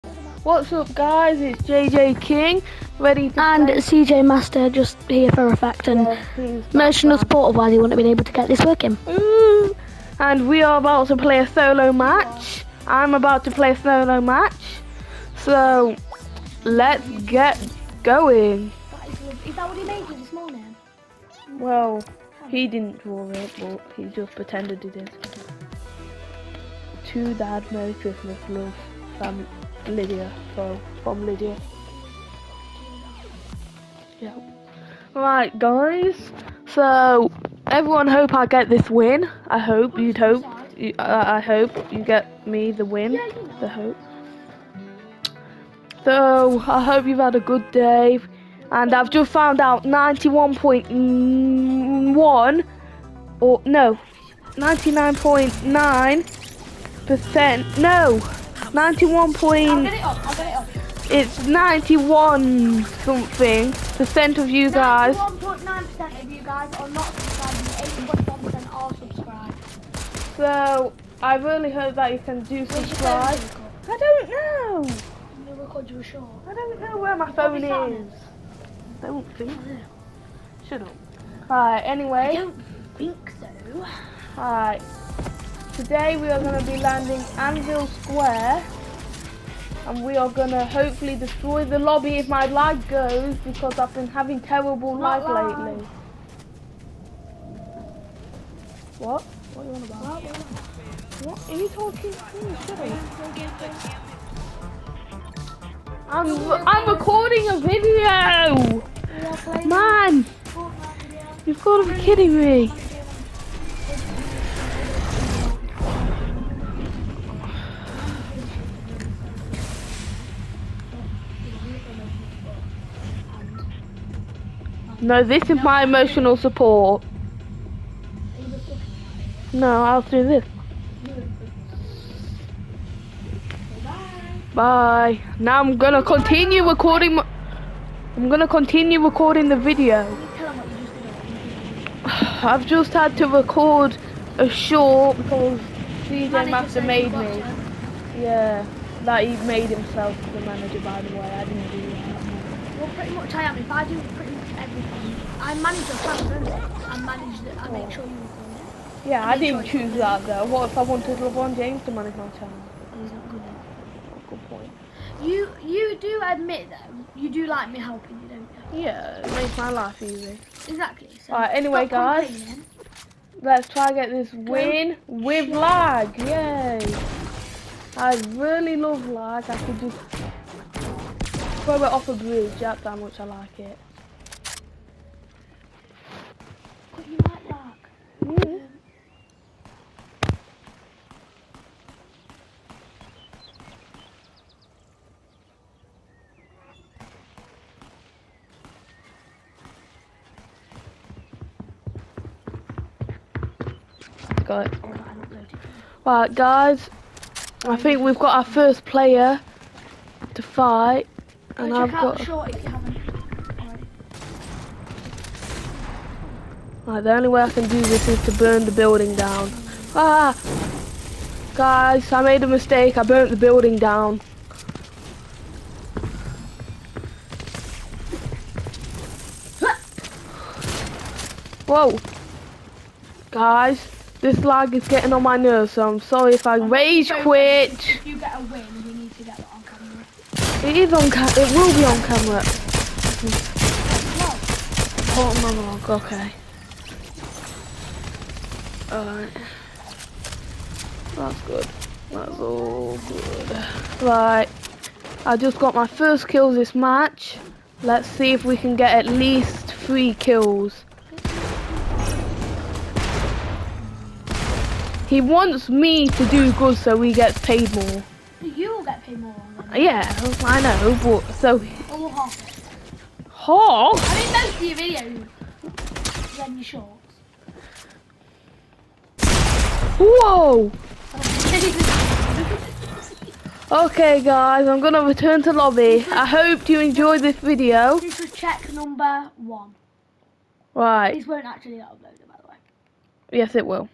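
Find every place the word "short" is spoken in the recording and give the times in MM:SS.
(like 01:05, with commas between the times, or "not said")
02:24, 04:36.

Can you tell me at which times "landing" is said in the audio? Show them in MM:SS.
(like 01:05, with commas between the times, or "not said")
01:26.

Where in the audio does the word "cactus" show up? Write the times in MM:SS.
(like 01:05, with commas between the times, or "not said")
not said.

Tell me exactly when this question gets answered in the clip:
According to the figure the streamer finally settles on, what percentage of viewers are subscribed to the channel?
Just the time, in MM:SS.
01:08.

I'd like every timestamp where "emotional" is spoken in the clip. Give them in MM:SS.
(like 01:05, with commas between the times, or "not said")
00:06, 02:05.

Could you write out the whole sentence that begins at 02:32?
Well pretty much I am, if I do pretty everything.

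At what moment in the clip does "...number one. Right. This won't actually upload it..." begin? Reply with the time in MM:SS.
04:48.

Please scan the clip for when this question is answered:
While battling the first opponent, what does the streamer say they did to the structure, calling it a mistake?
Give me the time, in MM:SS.
03:43.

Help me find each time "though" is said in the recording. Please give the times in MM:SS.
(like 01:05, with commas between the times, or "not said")
02:40, 02:46.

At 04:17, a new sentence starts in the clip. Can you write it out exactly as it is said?
Let's see if we can get at least three kills.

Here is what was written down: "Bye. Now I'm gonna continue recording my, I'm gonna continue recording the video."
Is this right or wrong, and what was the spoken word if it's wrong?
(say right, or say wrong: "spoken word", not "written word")
right.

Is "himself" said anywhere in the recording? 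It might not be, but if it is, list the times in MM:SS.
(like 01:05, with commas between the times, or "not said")
02:29.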